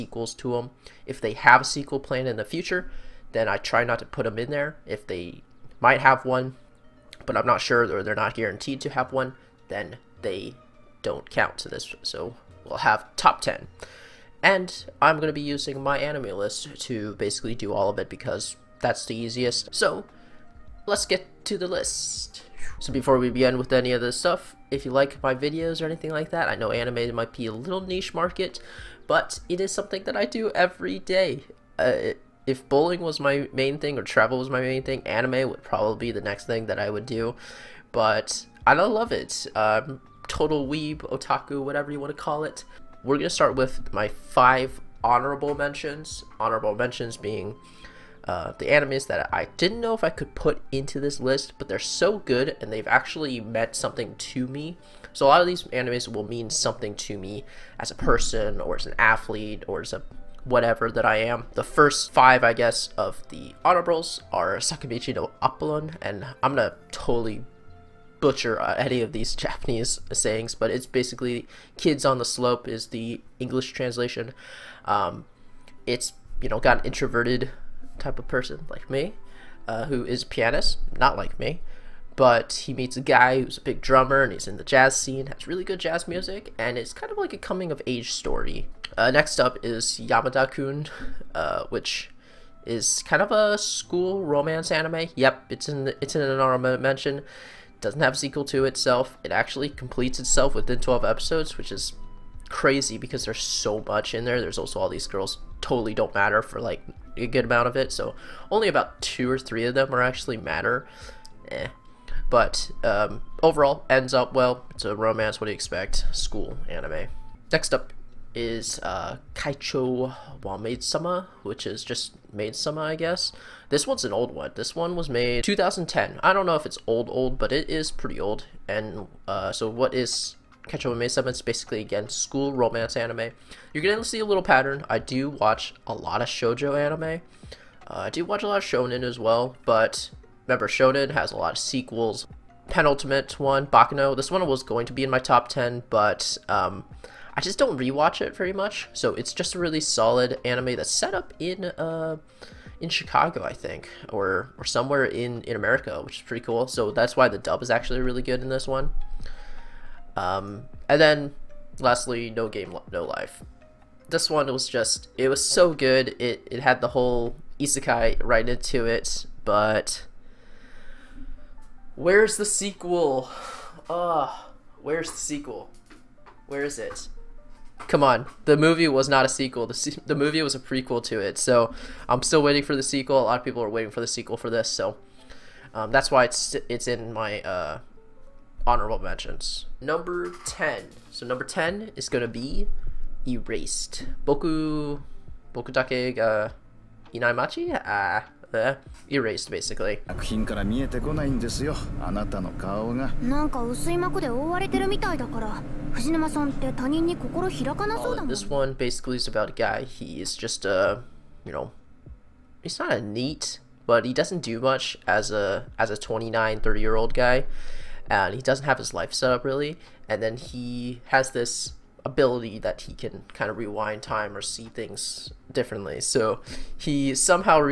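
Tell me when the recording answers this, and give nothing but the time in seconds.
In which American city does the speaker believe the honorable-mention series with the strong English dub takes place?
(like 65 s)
152 s.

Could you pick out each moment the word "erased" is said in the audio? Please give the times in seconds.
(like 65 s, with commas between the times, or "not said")
193 s, 199 s.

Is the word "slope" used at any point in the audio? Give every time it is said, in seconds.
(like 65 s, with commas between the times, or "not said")
72 s.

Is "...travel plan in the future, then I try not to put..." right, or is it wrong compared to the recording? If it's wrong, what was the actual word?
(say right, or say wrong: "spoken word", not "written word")
wrong: "sequel", not "travel".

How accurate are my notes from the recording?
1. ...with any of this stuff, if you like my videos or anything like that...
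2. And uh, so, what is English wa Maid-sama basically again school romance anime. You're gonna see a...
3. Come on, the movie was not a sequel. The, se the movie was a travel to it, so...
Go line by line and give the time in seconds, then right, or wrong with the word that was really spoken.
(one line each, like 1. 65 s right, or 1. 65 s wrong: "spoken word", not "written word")
1. 23 s right
2. 128 s wrong: "Kaicho", not "English"
3. 177 s wrong: "prequel", not "travel".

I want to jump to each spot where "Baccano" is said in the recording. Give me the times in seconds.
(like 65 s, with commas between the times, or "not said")
143 s.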